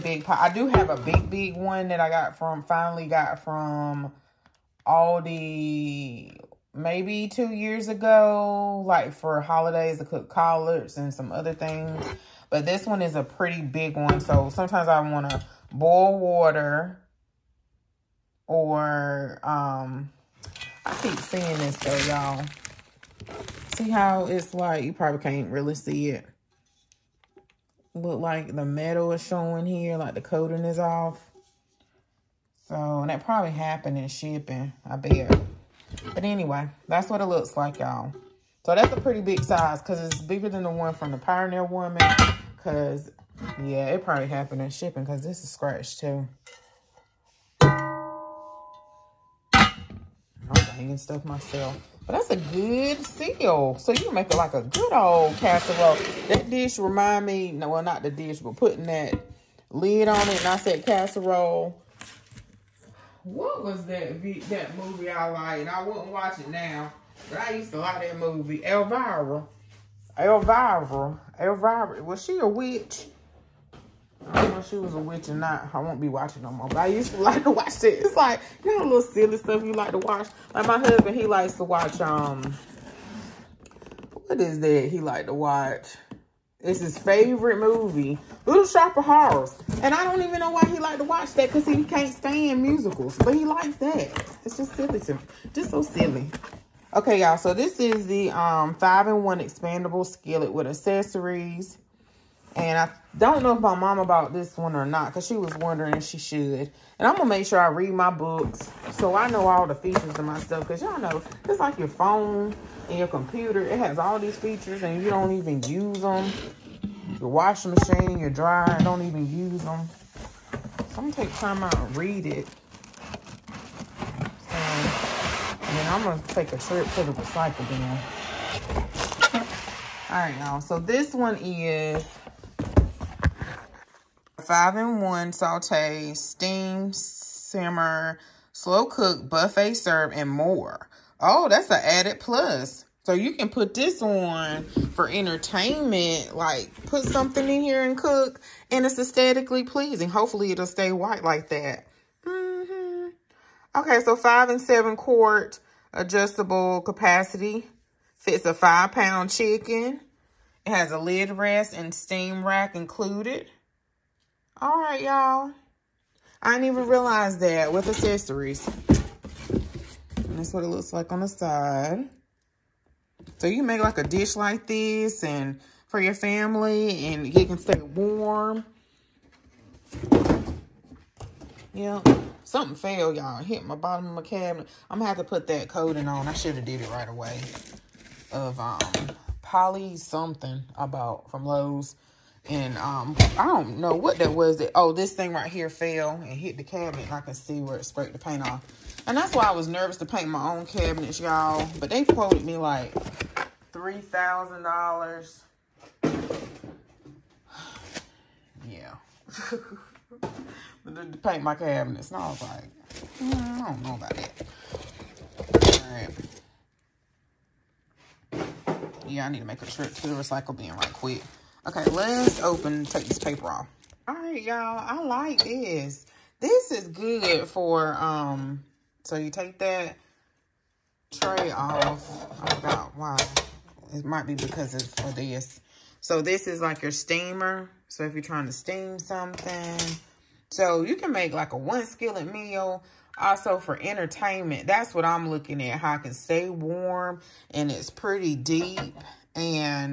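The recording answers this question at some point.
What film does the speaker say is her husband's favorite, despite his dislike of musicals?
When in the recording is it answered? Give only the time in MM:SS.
01:28.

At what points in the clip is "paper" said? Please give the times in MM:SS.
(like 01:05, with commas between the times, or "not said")
03:43.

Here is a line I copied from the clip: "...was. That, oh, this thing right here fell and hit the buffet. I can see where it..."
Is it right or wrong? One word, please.
wrong.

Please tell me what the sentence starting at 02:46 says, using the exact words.
I didn't even realize that with accessories.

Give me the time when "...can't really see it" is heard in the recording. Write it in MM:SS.
00:25.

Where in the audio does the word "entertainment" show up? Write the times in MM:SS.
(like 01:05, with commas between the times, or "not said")
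02:25, 04:03.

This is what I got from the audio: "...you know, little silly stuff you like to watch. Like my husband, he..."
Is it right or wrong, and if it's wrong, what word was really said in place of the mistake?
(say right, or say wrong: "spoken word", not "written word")
right.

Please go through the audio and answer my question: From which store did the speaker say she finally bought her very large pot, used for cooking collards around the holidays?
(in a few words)
Aldi.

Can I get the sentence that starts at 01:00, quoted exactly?
And I said casserole what was that that movie I liked?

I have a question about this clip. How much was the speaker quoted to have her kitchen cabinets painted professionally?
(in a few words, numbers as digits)
$3,000.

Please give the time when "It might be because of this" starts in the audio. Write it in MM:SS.
03:53.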